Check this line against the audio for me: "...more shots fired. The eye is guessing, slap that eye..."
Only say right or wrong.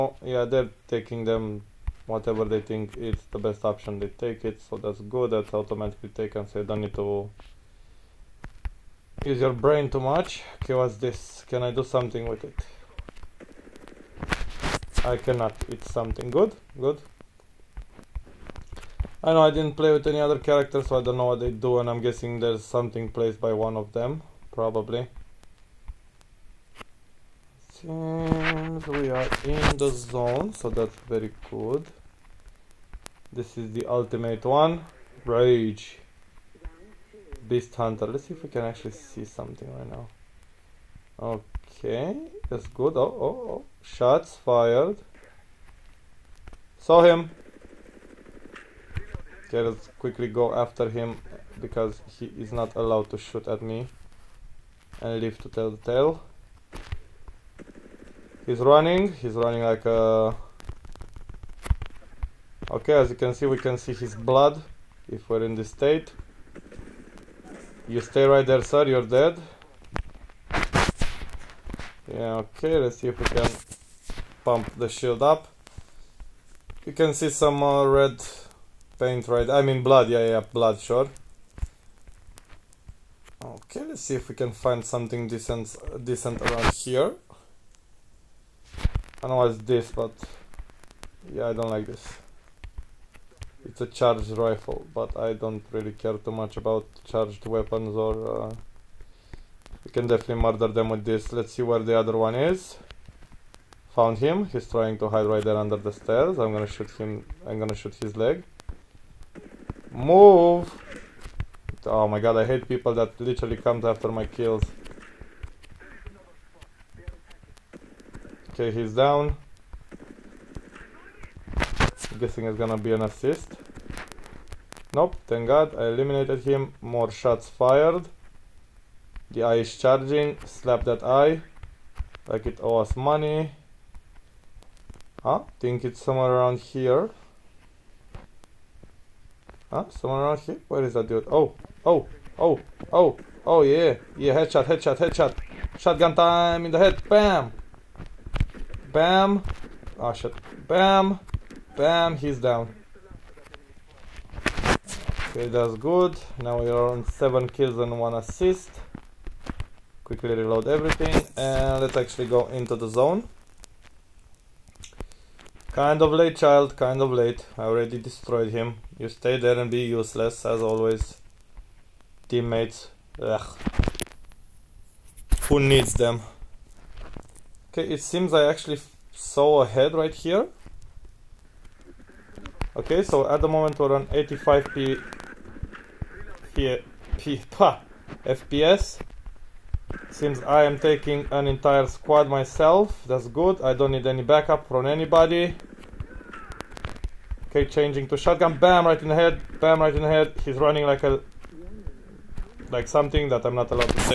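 wrong.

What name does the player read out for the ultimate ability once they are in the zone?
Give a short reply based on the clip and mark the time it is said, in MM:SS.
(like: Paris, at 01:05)
Beast Hunter, at 00:37.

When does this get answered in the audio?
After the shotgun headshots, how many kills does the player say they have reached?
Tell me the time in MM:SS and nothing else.
02:37.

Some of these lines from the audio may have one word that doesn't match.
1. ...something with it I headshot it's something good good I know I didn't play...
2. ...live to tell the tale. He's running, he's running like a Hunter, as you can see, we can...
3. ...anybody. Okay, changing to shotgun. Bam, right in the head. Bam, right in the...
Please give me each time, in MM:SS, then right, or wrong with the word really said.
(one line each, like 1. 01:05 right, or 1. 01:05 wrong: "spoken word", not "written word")
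1. 00:11 wrong: "cannot", not "headshot"
2. 00:55 wrong: "Okay", not "Hunter"
3. 03:14 right.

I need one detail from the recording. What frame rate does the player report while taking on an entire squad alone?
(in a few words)
85 FPS.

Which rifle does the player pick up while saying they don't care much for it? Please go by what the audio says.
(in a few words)
Charged rifle.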